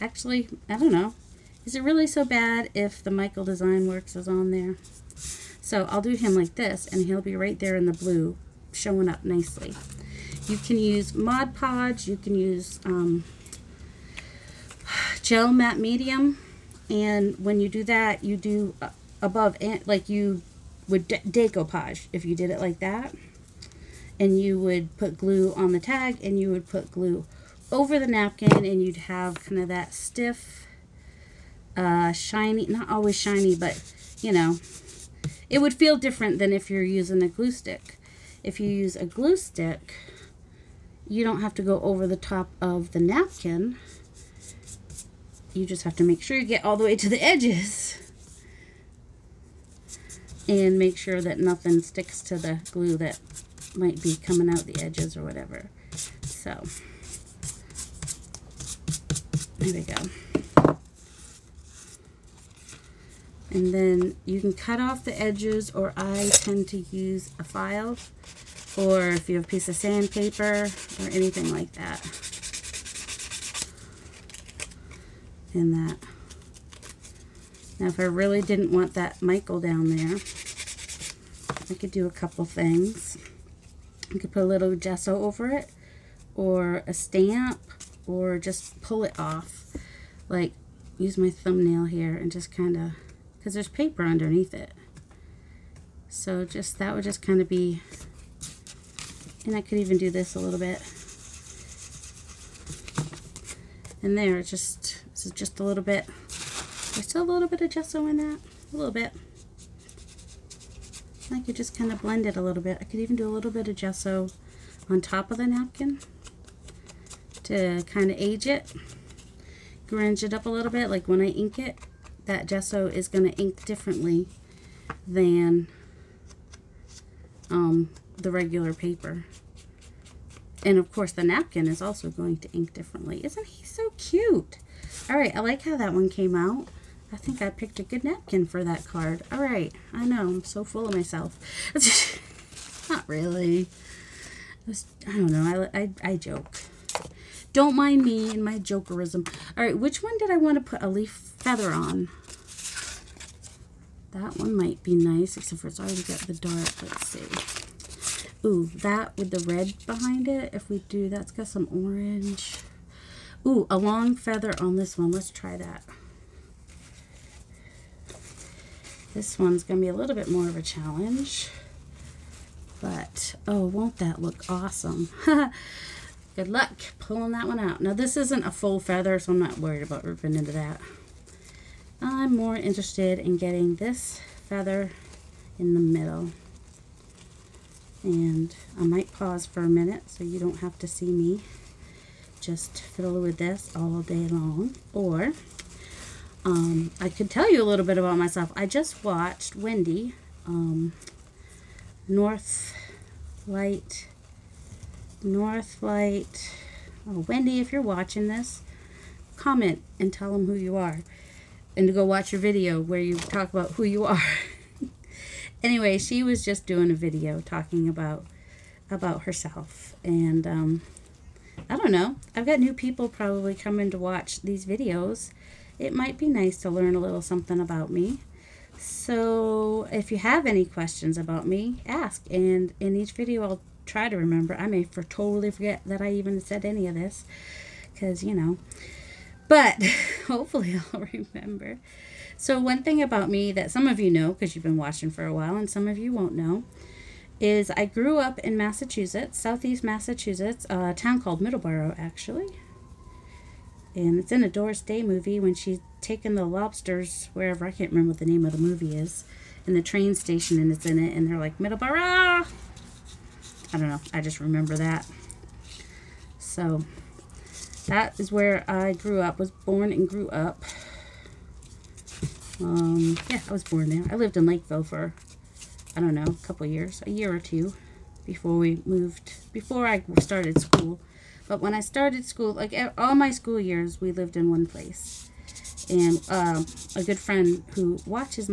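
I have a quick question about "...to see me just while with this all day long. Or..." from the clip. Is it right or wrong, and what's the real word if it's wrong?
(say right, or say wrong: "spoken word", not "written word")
wrong: "fiddle", not "while".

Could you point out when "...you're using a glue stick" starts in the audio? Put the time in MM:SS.
00:36.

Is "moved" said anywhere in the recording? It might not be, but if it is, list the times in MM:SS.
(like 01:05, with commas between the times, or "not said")
04:38.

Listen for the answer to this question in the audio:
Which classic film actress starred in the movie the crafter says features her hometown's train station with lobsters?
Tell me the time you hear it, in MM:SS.
04:14.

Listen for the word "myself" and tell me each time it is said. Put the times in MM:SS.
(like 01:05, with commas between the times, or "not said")
02:20, 03:18.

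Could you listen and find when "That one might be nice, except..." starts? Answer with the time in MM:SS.
02:34.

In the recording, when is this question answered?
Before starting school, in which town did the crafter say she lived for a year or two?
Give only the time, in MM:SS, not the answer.
04:34.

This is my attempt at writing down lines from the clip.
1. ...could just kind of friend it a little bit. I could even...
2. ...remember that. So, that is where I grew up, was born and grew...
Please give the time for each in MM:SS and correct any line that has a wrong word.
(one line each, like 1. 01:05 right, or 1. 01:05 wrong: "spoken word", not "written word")
1. 01:51 wrong: "blend", not "friend"
2. 04:24 right.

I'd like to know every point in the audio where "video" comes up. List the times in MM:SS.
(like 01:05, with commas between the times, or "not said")
03:32, 03:36, 03:44, 03:53.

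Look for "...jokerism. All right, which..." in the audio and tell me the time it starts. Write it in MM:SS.
02:28.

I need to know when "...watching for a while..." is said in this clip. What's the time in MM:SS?
04:04.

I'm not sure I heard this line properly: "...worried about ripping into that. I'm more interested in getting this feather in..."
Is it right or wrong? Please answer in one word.
right.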